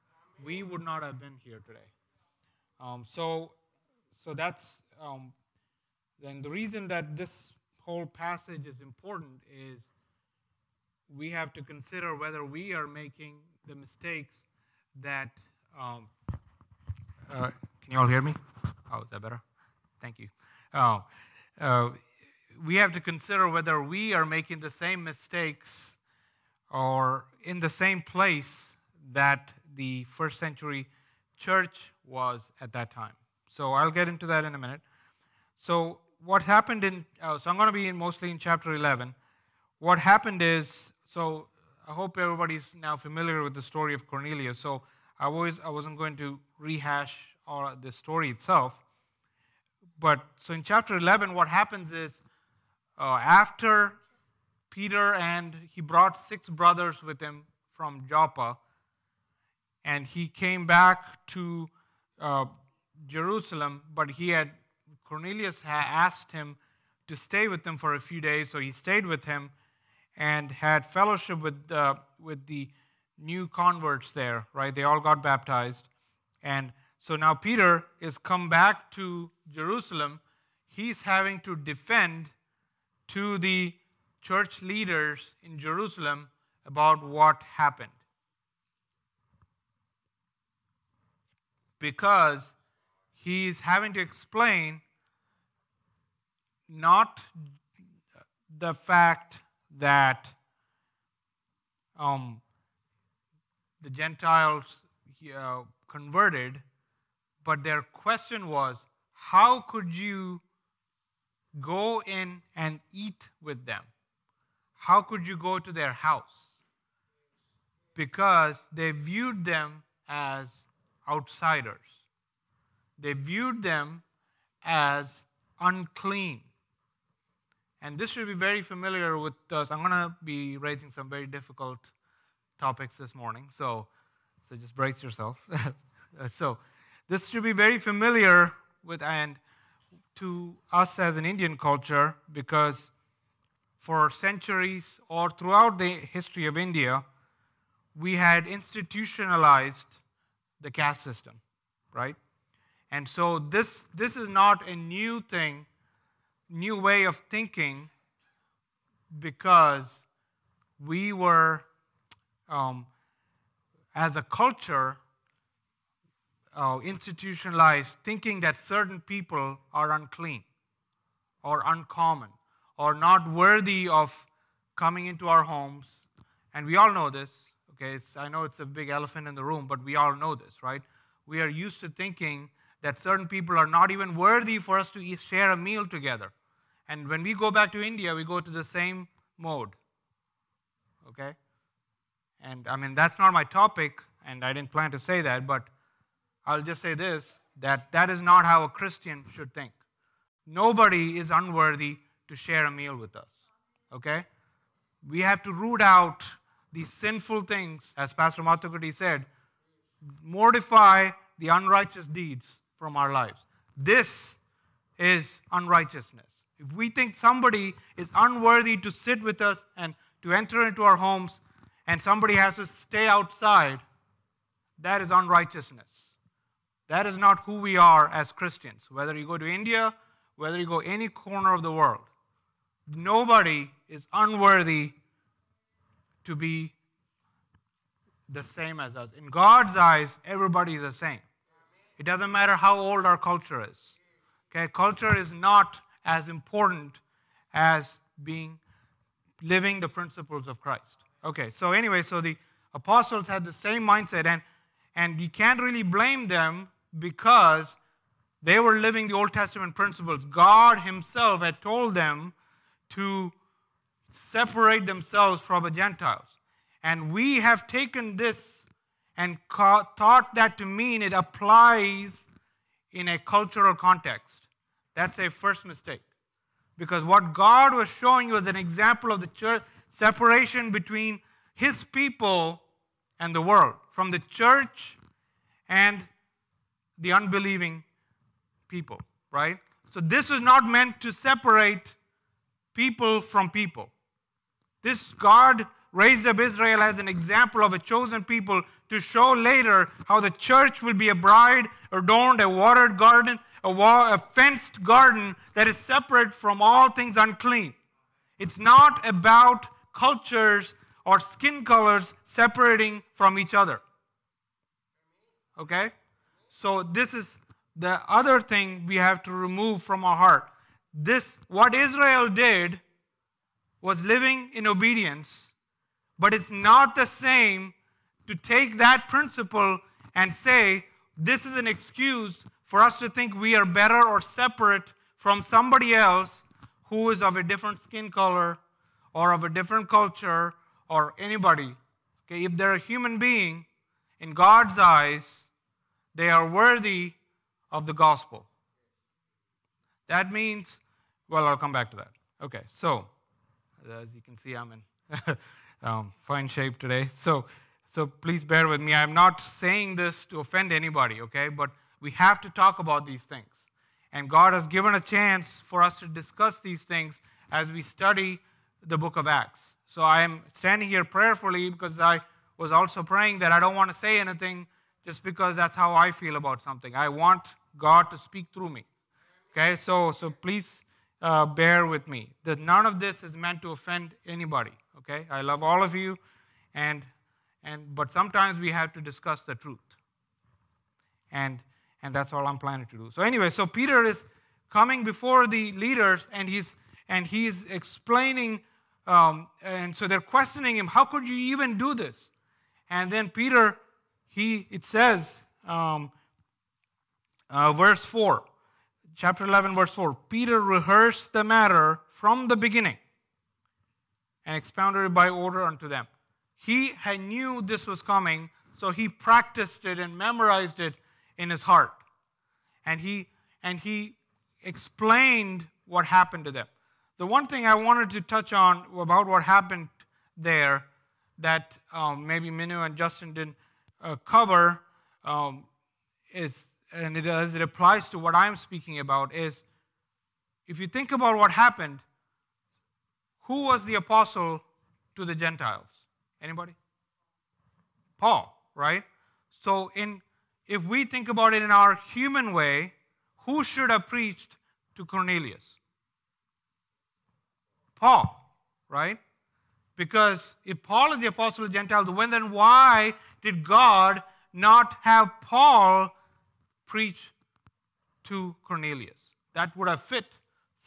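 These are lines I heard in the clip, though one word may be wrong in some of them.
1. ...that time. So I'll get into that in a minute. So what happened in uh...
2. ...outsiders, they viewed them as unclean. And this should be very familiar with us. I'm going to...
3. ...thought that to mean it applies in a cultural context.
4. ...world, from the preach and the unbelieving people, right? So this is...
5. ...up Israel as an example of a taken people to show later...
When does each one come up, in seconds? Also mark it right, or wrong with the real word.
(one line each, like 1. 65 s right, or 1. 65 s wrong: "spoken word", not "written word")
1. 32 s right
2. 121 s right
3. 269 s right
4. 283 s wrong: "church", not "preach"
5. 296 s wrong: "chosen", not "taken".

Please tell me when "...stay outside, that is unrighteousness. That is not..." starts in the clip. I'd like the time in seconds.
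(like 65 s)
222 s.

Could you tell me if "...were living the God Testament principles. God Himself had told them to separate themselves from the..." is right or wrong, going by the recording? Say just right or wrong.
wrong.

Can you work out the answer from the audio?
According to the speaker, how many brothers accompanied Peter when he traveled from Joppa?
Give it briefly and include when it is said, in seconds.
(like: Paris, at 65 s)
6, at 56 s.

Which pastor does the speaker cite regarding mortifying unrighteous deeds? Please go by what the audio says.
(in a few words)
Pastor Mathukuti.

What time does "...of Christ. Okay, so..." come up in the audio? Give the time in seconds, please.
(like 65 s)
250 s.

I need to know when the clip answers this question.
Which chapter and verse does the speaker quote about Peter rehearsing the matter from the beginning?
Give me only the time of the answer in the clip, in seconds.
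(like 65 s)
409 s.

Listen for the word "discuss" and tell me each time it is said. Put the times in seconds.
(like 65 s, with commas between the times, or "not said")
366 s, 389 s.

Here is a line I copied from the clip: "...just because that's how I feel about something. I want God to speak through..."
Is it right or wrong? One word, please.
right.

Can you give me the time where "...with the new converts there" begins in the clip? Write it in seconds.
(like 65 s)
72 s.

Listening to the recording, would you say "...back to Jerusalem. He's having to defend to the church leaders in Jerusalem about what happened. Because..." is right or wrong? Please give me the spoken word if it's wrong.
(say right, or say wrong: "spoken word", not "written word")
right.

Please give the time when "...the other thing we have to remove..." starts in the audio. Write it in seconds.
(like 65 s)
317 s.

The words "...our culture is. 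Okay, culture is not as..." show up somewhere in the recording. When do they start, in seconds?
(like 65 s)
243 s.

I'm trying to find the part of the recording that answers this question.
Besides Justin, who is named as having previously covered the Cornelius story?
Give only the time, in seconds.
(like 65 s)
432 s.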